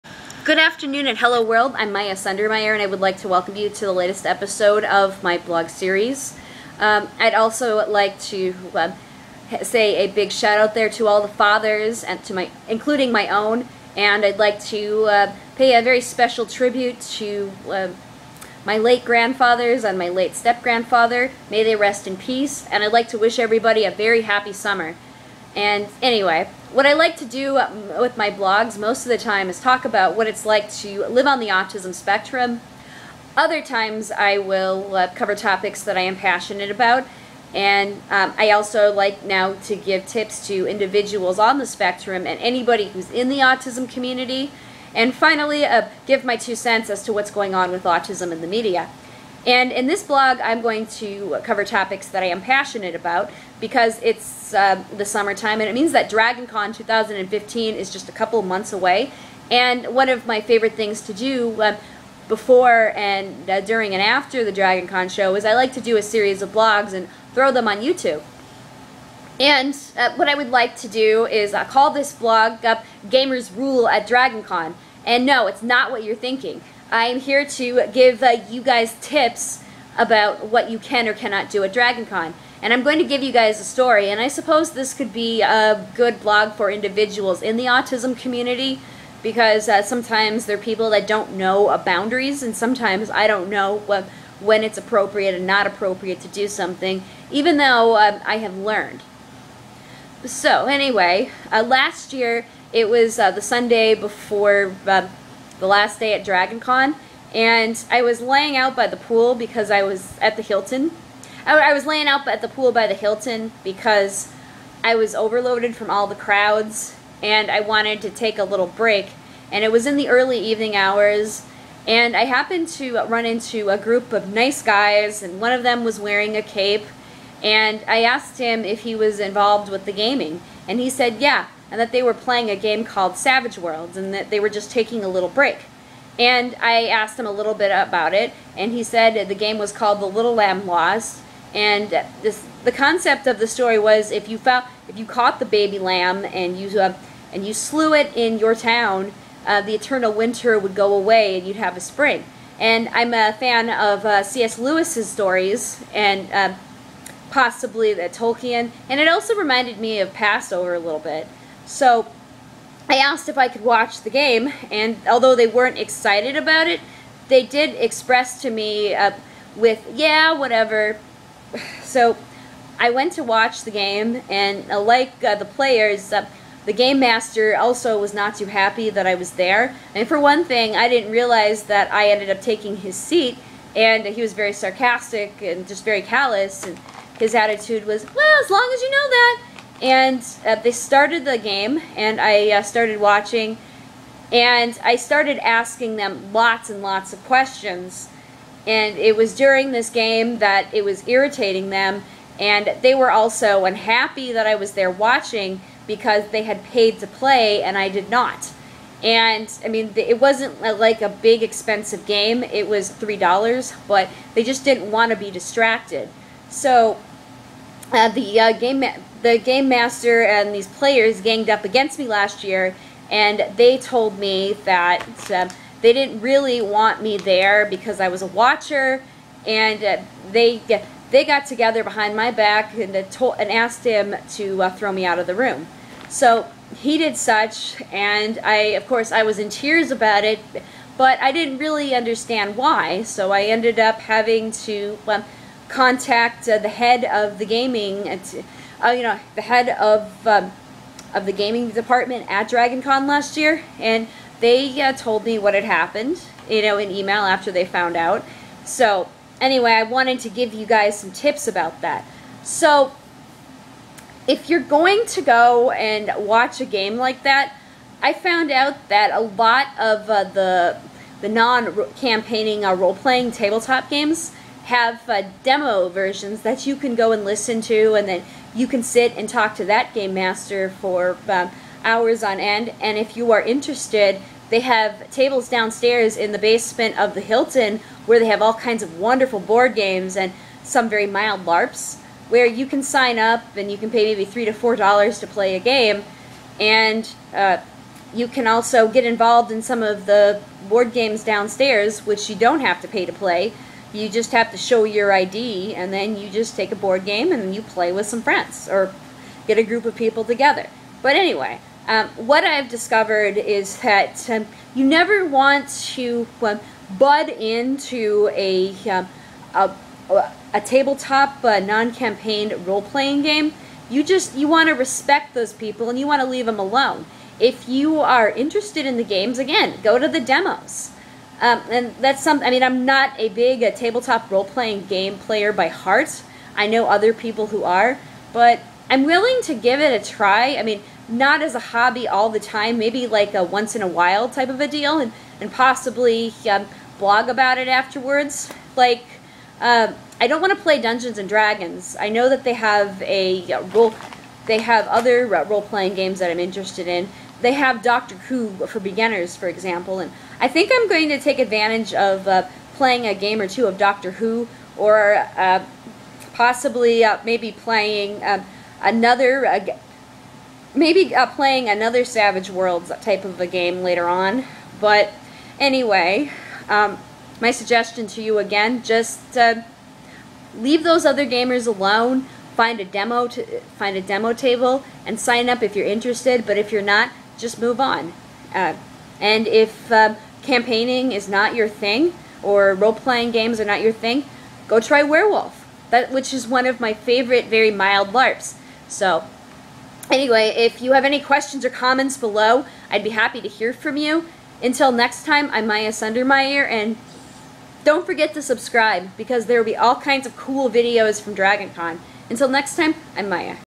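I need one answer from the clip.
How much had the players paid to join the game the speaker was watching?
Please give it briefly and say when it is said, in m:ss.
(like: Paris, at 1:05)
$3, at 3:32.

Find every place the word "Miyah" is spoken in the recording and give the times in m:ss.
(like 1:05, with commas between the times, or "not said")
0:01, 6:45, 6:53.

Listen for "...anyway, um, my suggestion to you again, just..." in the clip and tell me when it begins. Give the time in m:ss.
6:15.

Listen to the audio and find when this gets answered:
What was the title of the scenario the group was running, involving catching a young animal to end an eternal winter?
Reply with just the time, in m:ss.
2:20.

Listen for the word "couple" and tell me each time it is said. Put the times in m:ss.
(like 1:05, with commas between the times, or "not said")
0:58.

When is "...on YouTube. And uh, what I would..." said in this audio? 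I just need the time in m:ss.
1:07.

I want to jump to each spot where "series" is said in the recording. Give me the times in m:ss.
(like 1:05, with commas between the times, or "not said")
0:05, 1:06.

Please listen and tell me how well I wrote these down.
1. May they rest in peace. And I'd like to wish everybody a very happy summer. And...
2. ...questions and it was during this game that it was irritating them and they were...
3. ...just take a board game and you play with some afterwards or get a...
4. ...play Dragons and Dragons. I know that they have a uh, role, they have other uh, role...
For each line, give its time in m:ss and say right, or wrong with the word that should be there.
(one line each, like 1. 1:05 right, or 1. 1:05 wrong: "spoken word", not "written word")
1. 0:21 right
2. 3:17 right
3. 5:06 wrong: "friends", not "afterwards"
4. 5:50 wrong: "Dungeons", not "Dragons".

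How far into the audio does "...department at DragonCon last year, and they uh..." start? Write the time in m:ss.
4:11.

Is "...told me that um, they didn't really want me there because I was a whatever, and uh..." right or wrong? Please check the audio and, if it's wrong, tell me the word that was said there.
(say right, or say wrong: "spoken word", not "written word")
wrong: "watcher", not "whatever".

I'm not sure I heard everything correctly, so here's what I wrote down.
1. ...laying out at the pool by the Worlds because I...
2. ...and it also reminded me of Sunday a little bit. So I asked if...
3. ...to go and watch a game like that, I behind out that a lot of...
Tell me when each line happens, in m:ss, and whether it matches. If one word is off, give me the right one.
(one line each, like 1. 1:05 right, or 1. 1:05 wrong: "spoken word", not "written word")
1. 1:51 wrong: "Hilton", not "Worlds"
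2. 2:38 wrong: "Passover", not "Sunday"
3. 4:25 wrong: "found", not "behind".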